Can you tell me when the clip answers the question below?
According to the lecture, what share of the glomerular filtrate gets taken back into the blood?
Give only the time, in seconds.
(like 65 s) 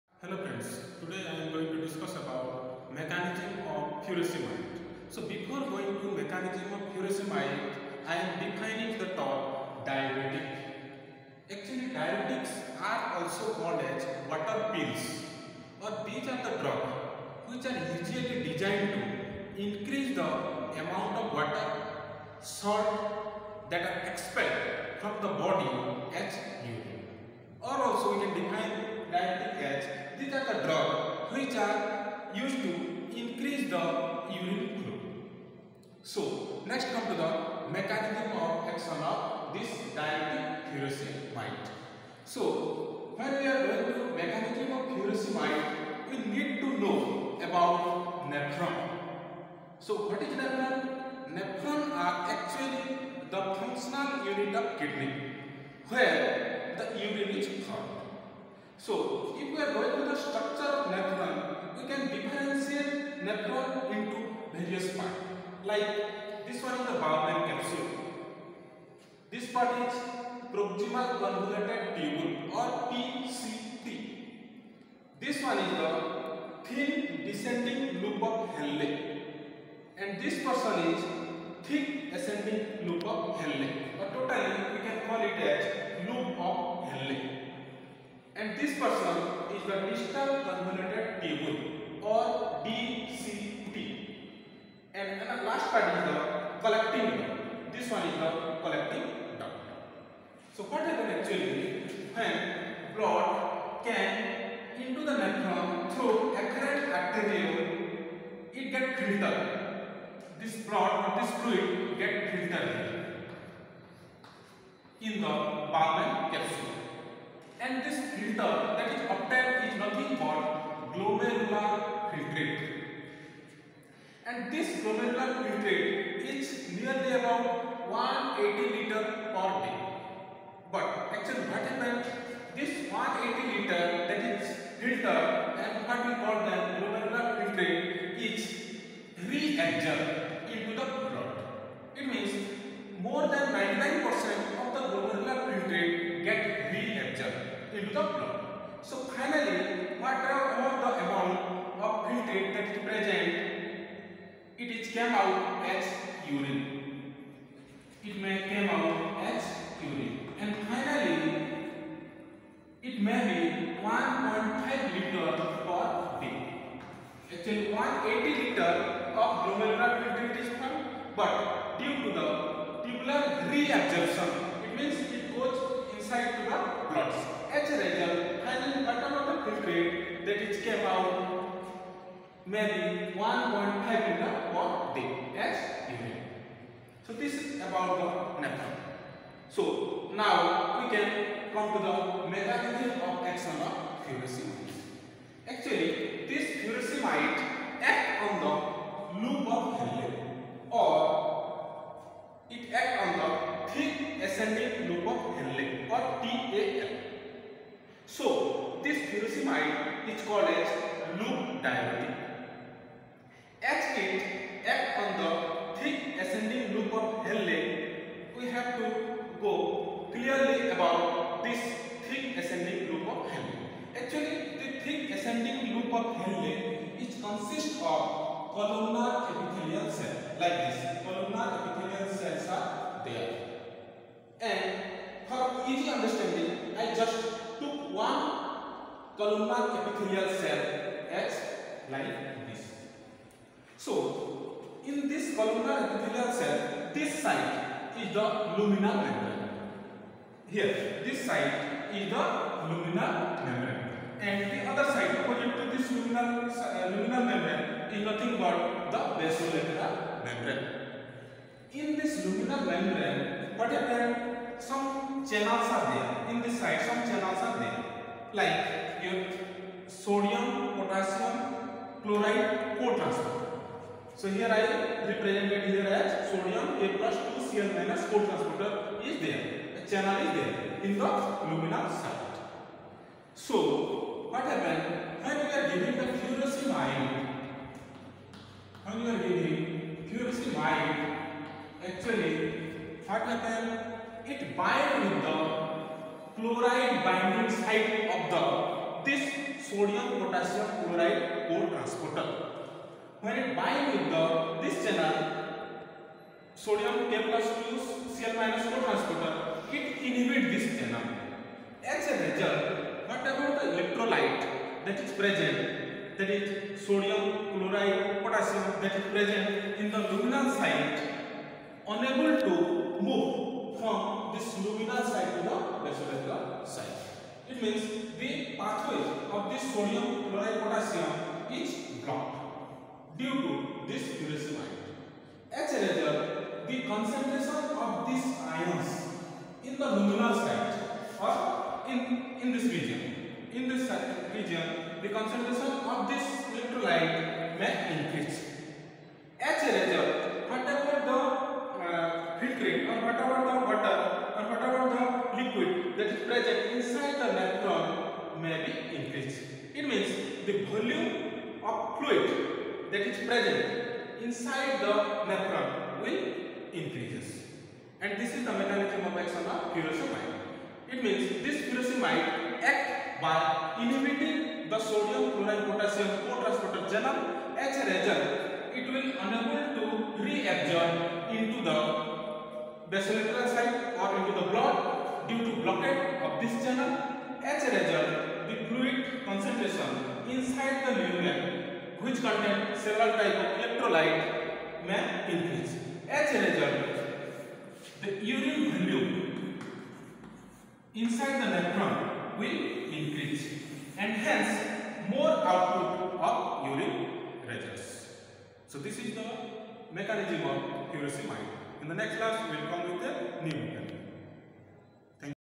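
143 s.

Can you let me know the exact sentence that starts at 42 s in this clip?
So when we are going to mechanism of furosemide, we need to know about nephron.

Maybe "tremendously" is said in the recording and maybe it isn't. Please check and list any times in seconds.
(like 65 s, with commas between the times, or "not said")
not said.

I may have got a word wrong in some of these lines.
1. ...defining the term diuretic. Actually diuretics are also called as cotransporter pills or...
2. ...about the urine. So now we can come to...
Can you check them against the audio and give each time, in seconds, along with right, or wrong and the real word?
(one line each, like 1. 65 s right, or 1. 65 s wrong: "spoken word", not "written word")
1. 8 s wrong: "water", not "cotransporter"
2. 187 s wrong: "naphthalene", not "urine".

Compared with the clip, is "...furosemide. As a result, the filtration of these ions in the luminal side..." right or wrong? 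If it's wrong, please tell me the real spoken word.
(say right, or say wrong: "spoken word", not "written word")
wrong: "concentration", not "filtration".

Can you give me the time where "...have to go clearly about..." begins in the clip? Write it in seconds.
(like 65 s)
218 s.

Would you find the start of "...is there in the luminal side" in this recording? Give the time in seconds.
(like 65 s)
280 s.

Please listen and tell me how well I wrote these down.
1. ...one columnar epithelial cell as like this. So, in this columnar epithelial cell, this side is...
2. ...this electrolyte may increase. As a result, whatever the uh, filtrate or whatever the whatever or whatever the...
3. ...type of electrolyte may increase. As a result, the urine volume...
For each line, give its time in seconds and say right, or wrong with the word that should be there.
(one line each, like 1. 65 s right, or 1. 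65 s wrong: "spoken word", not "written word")
1. 237 s right
2. 346 s wrong: "water", not "whatever"
3. 393 s right.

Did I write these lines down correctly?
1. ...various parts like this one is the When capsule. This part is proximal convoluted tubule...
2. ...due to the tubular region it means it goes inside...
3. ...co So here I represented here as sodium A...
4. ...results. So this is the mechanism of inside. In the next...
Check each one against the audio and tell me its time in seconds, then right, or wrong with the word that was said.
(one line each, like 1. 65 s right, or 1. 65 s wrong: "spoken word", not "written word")
1. 64 s wrong: "Bowman", not "When"
2. 171 s wrong: "reabsorption", not "region"
3. 272 s right
4. 407 s wrong: "furosemide", not "inside".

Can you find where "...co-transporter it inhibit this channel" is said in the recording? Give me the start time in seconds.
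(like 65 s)
308 s.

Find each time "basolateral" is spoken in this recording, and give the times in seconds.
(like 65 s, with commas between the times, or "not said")
259 s, 325 s, 382 s.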